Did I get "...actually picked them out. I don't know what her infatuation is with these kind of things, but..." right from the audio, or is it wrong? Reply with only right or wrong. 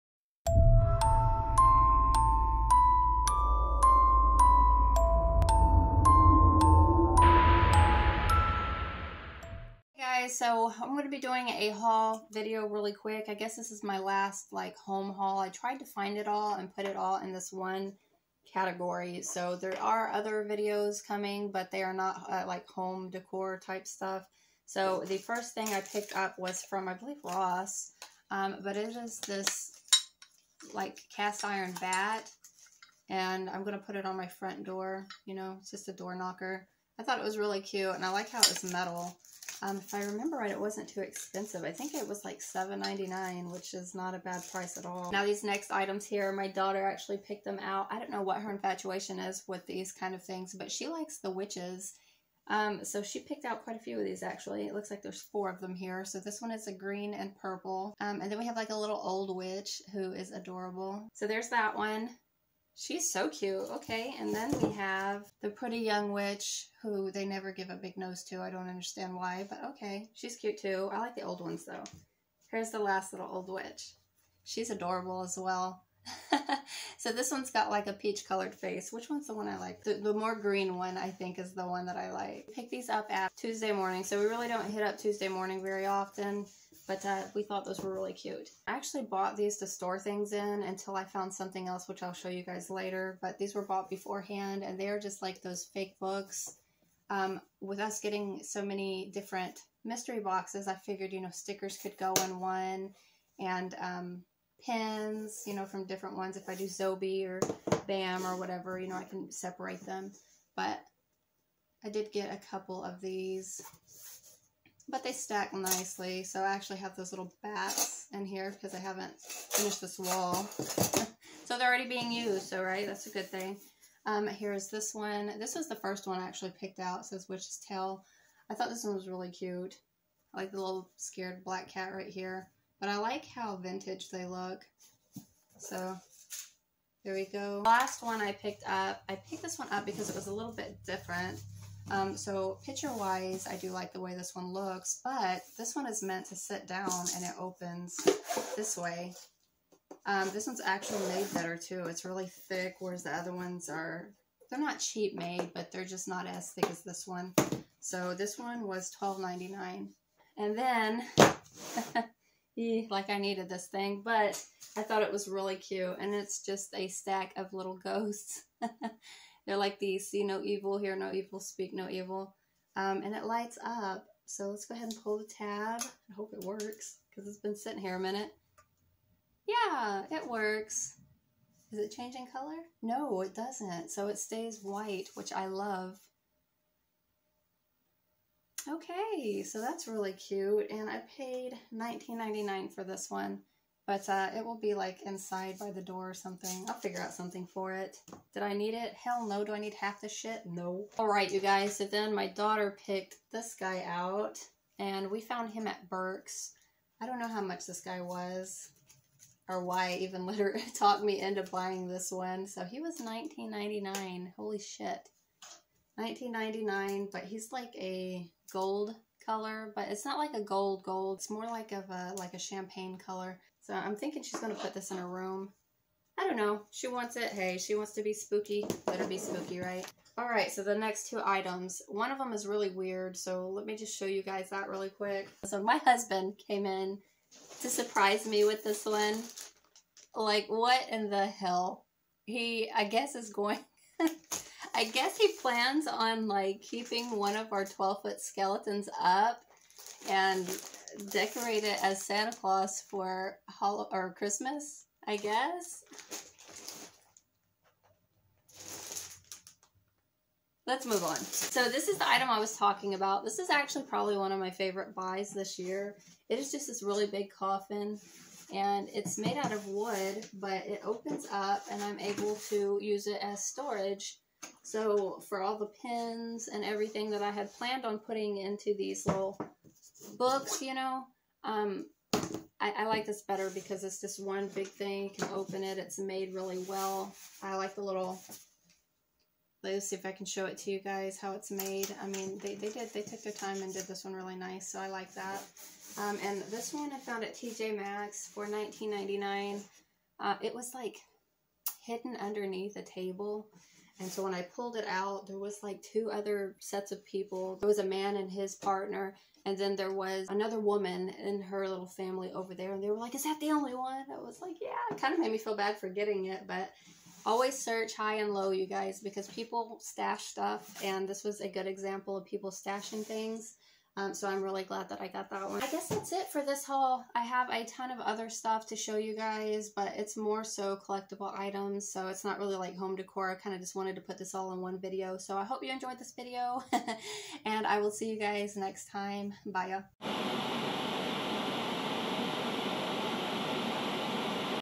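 right.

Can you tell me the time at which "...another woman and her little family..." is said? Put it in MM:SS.
05:10.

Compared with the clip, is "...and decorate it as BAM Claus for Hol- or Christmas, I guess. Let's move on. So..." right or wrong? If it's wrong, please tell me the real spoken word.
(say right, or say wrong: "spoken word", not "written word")
wrong: "Santa", not "BAM".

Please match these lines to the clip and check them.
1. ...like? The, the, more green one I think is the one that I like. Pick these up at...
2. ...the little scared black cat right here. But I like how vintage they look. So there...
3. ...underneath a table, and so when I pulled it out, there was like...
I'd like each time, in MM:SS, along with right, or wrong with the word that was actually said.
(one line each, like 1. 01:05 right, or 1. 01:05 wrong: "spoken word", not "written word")
1. 01:19 right
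2. 02:10 right
3. 05:02 right.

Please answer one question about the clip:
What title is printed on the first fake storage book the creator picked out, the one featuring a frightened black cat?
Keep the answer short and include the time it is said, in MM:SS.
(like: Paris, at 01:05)
Witch's Tail, at 02:07.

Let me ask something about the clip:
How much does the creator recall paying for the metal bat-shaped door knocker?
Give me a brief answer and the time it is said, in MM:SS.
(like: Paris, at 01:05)
$7.99, at 00:42.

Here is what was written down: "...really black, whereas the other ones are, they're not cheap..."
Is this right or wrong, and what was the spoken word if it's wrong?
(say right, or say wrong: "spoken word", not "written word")
wrong: "thick", not "black".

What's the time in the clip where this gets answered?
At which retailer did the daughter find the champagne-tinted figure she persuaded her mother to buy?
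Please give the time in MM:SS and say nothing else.
03:25.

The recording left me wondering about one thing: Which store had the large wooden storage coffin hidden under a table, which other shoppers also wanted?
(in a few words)
TJ Maxx.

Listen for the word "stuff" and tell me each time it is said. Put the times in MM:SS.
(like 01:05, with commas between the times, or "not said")
00:23, 05:20, 05:28.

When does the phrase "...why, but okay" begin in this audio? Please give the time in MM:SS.
01:09.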